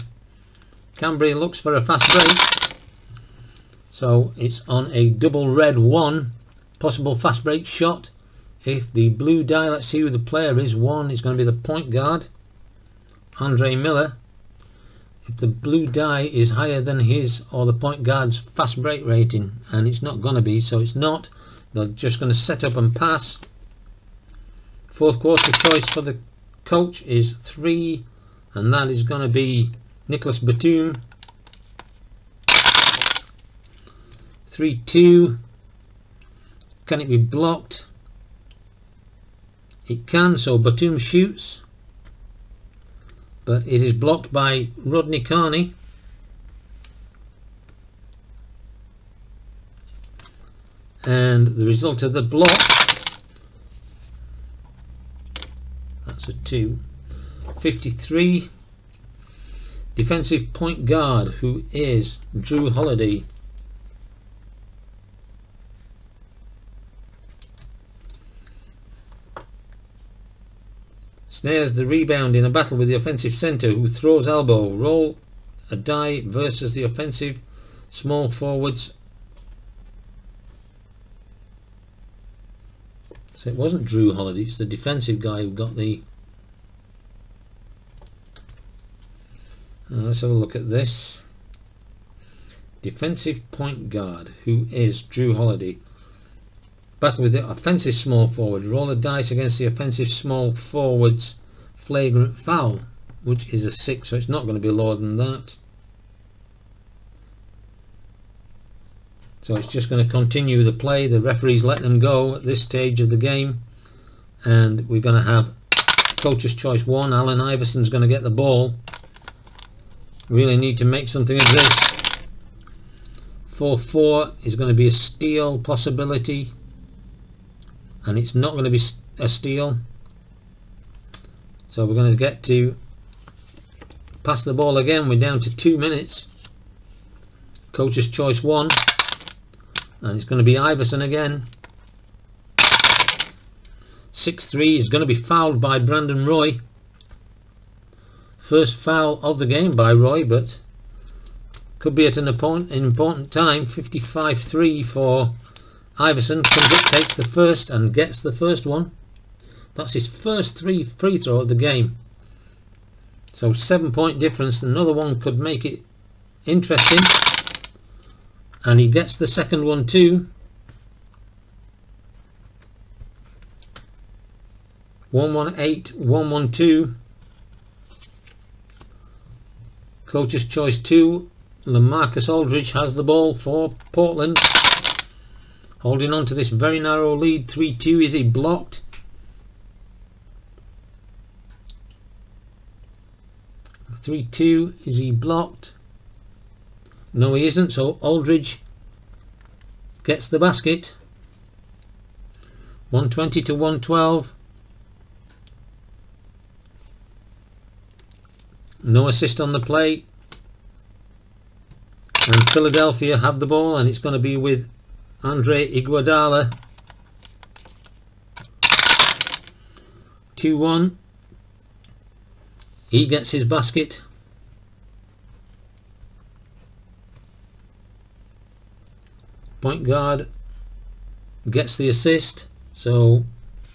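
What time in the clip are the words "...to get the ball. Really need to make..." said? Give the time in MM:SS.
01:58.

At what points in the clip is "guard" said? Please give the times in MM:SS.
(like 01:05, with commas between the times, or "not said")
00:11, 00:18, 01:00, 01:33, 03:49.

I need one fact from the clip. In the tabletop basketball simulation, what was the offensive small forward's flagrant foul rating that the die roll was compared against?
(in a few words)
6.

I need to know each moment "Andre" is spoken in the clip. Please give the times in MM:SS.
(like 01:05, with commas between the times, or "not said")
00:13, 03:35.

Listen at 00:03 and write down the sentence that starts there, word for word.
So it's on a double red 1 Possible fast break shot.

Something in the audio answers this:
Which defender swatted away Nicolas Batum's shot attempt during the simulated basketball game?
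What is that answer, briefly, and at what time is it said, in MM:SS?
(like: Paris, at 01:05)
Rodney Carney, at 00:44.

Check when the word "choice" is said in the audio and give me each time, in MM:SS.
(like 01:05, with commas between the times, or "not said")
00:25, 01:56, 02:18, 03:00.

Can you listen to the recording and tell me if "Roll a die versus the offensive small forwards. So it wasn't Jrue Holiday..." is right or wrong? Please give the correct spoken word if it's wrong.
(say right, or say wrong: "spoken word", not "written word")
right.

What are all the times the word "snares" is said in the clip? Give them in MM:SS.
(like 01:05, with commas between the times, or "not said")
01:11.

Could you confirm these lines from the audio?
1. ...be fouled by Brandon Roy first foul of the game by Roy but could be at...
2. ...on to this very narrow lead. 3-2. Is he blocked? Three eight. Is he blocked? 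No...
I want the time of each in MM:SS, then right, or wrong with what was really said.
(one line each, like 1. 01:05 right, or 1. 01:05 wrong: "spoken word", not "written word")
1. 02:25 right
2. 03:06 wrong: "two", not "eight".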